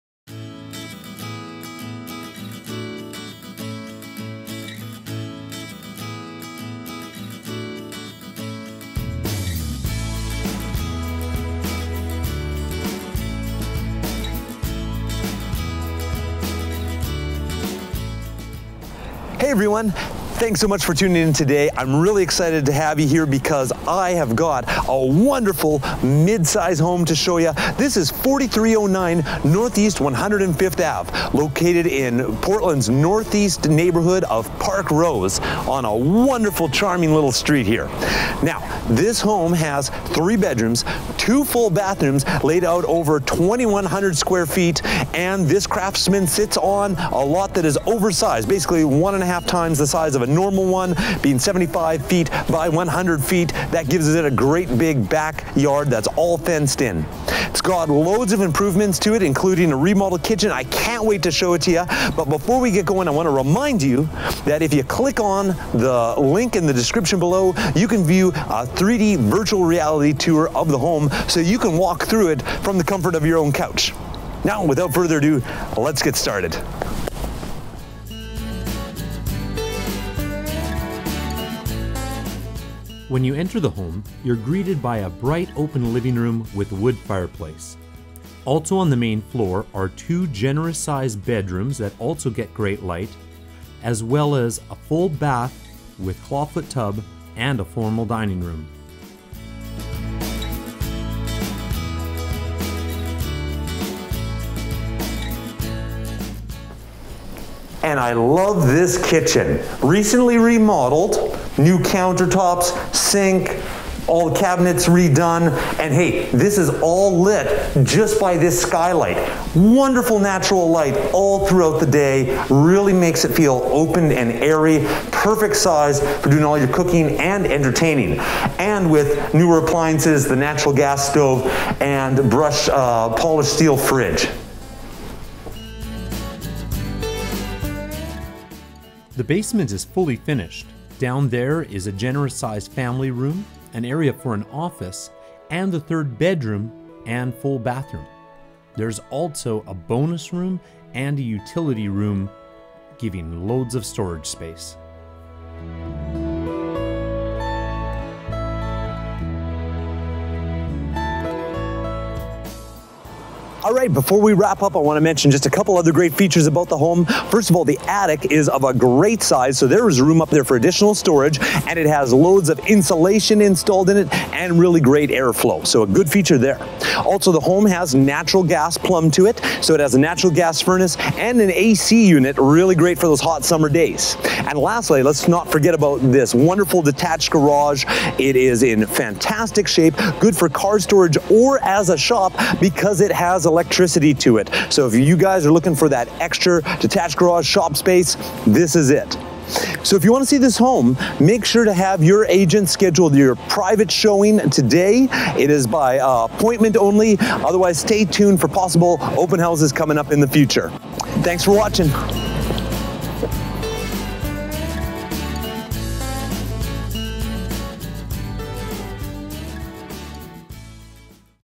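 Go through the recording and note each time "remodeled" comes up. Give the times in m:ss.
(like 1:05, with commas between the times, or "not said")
0:59, 1:50.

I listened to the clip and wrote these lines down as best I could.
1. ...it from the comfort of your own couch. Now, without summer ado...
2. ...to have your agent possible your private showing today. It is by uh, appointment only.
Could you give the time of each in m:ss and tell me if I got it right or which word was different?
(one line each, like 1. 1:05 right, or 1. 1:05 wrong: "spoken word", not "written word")
1. 1:12 wrong: "further", not "summer"
2. 3:21 wrong: "schedule", not "possible".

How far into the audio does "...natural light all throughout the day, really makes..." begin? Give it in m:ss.
2:00.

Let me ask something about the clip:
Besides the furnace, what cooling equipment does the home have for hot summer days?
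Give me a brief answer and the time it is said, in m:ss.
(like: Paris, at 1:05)
AC unit, at 3:01.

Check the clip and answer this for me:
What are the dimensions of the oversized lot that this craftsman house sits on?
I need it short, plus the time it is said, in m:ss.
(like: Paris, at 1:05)
75 feet by 100 feet, at 0:51.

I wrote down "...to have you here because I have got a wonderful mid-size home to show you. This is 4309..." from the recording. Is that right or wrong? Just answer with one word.
right.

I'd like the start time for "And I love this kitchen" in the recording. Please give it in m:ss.
1:47.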